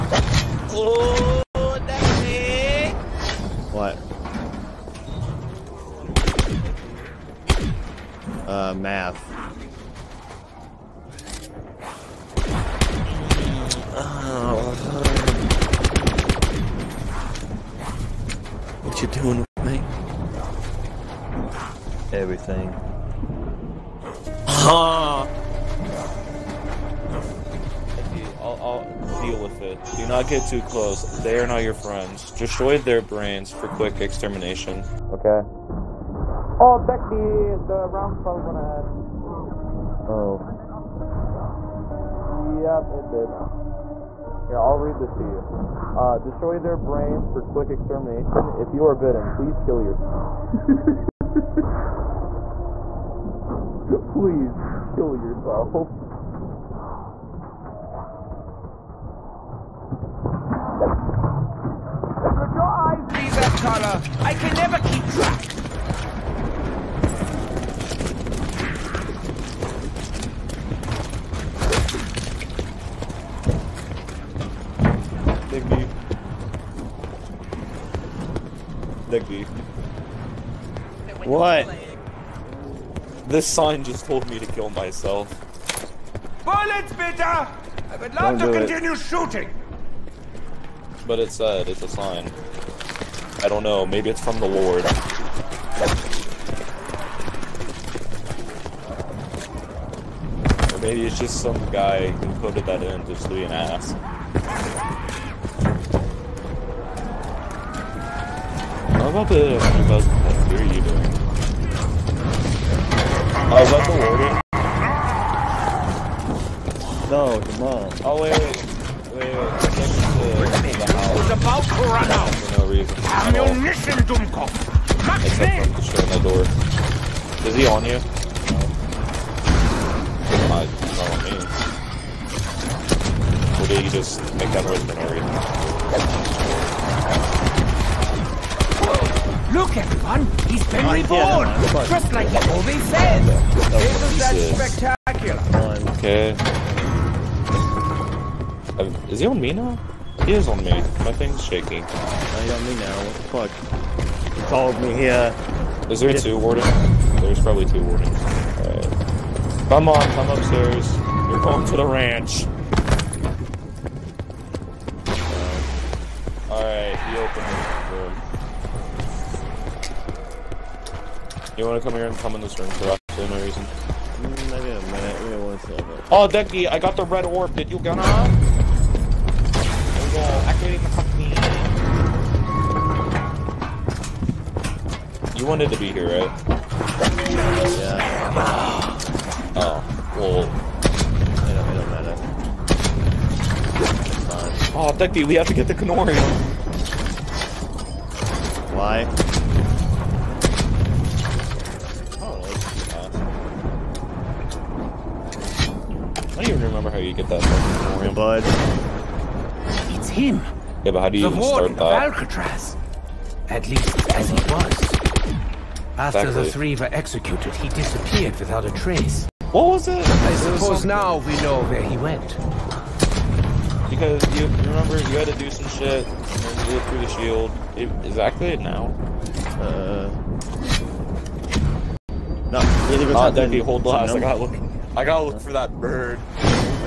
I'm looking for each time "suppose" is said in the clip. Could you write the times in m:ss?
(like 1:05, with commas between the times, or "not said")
3:40.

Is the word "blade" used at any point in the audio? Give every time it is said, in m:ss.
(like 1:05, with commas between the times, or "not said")
not said.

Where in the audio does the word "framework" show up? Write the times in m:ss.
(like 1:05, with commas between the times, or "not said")
not said.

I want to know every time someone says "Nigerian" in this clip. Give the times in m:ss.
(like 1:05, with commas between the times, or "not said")
not said.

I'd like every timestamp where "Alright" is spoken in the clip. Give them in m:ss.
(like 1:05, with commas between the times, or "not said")
2:38, 2:46.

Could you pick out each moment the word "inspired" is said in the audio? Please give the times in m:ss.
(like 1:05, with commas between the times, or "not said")
not said.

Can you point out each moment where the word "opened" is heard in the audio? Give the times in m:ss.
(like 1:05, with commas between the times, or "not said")
2:47.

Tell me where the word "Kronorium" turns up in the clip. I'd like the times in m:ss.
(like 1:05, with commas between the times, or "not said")
3:15, 3:27.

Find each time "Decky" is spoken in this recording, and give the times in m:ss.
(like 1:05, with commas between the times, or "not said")
2:56.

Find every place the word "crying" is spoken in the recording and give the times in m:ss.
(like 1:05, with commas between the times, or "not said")
not said.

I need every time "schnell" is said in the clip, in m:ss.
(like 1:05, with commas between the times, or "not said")
2:05.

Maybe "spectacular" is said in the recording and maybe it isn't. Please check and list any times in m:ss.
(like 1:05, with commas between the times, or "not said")
2:24.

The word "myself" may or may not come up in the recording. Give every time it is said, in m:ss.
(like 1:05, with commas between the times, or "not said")
1:24.